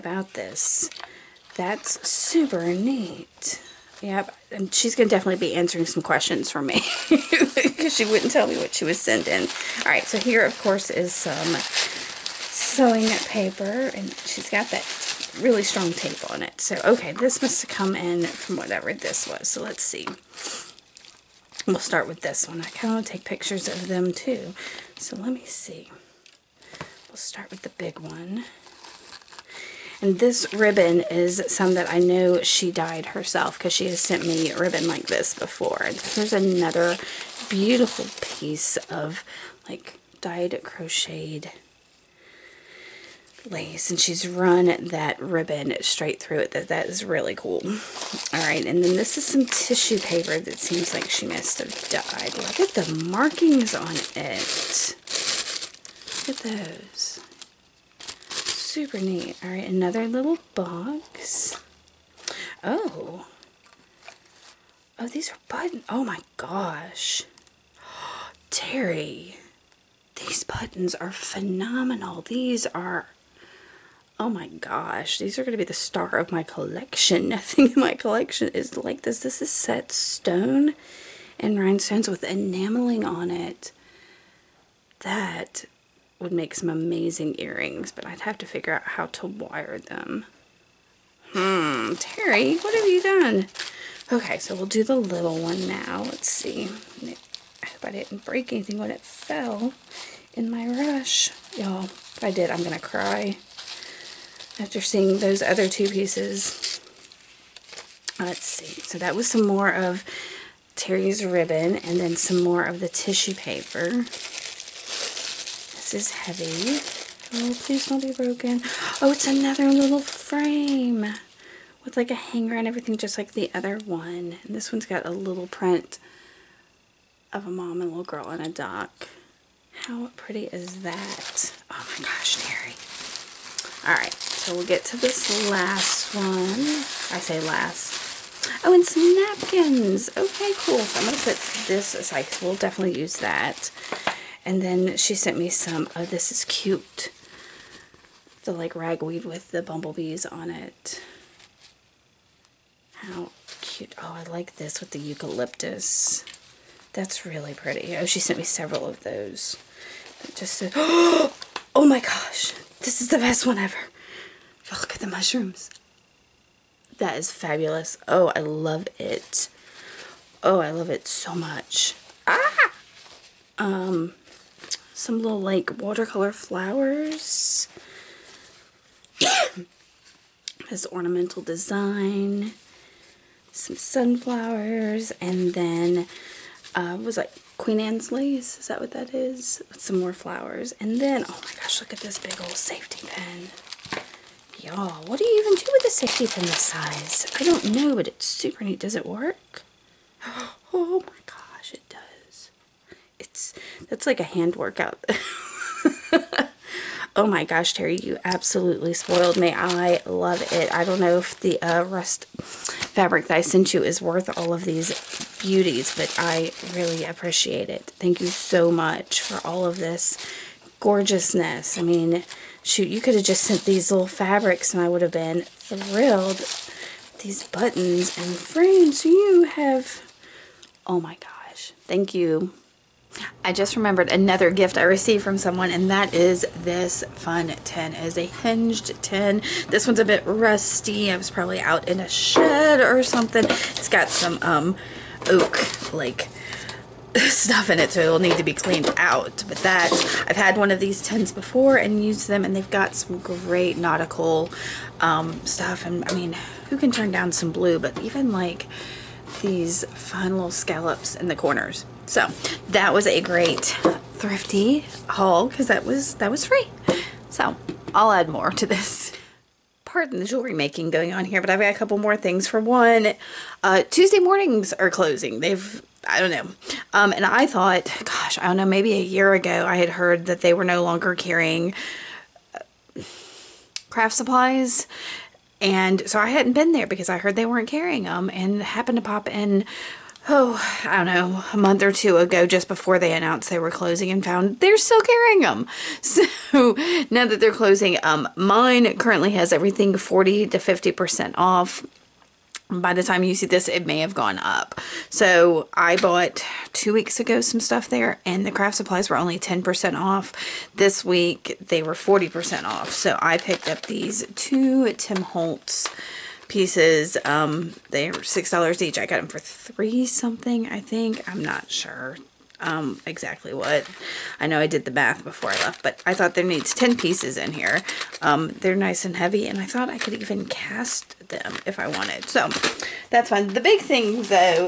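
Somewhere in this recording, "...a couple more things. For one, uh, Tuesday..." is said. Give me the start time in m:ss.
4:31.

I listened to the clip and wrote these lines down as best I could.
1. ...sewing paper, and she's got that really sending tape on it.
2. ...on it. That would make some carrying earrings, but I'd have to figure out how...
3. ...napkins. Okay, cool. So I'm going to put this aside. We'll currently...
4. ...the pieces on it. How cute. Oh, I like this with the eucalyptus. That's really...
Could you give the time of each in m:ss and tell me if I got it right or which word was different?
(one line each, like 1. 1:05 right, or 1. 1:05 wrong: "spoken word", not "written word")
1. 0:11 wrong: "strong", not "sending"
2. 1:23 wrong: "amazing", not "carrying"
3. 2:19 wrong: "definitely", not "currently"
4. 2:29 wrong: "bumblebees", not "pieces".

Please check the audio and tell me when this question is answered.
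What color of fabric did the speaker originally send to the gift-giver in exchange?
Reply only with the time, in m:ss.
3:31.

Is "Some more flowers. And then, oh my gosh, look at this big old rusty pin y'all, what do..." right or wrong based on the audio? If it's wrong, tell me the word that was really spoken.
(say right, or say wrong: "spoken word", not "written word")
wrong: "safety", not "rusty".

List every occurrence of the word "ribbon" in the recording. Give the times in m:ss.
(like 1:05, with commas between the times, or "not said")
0:30, 0:34, 0:45, 1:51.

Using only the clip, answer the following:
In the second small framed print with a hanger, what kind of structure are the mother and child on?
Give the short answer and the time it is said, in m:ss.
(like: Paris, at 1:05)
a dock, at 2:08.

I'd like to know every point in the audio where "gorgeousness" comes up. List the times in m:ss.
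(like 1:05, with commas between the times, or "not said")
3:40.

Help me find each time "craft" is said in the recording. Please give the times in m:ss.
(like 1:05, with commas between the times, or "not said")
4:43, 5:08.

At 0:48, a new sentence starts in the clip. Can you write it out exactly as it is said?
Alright, and then this is some tissue paper that seems like she must have dyed.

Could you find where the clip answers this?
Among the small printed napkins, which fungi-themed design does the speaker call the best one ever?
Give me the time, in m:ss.
2:45.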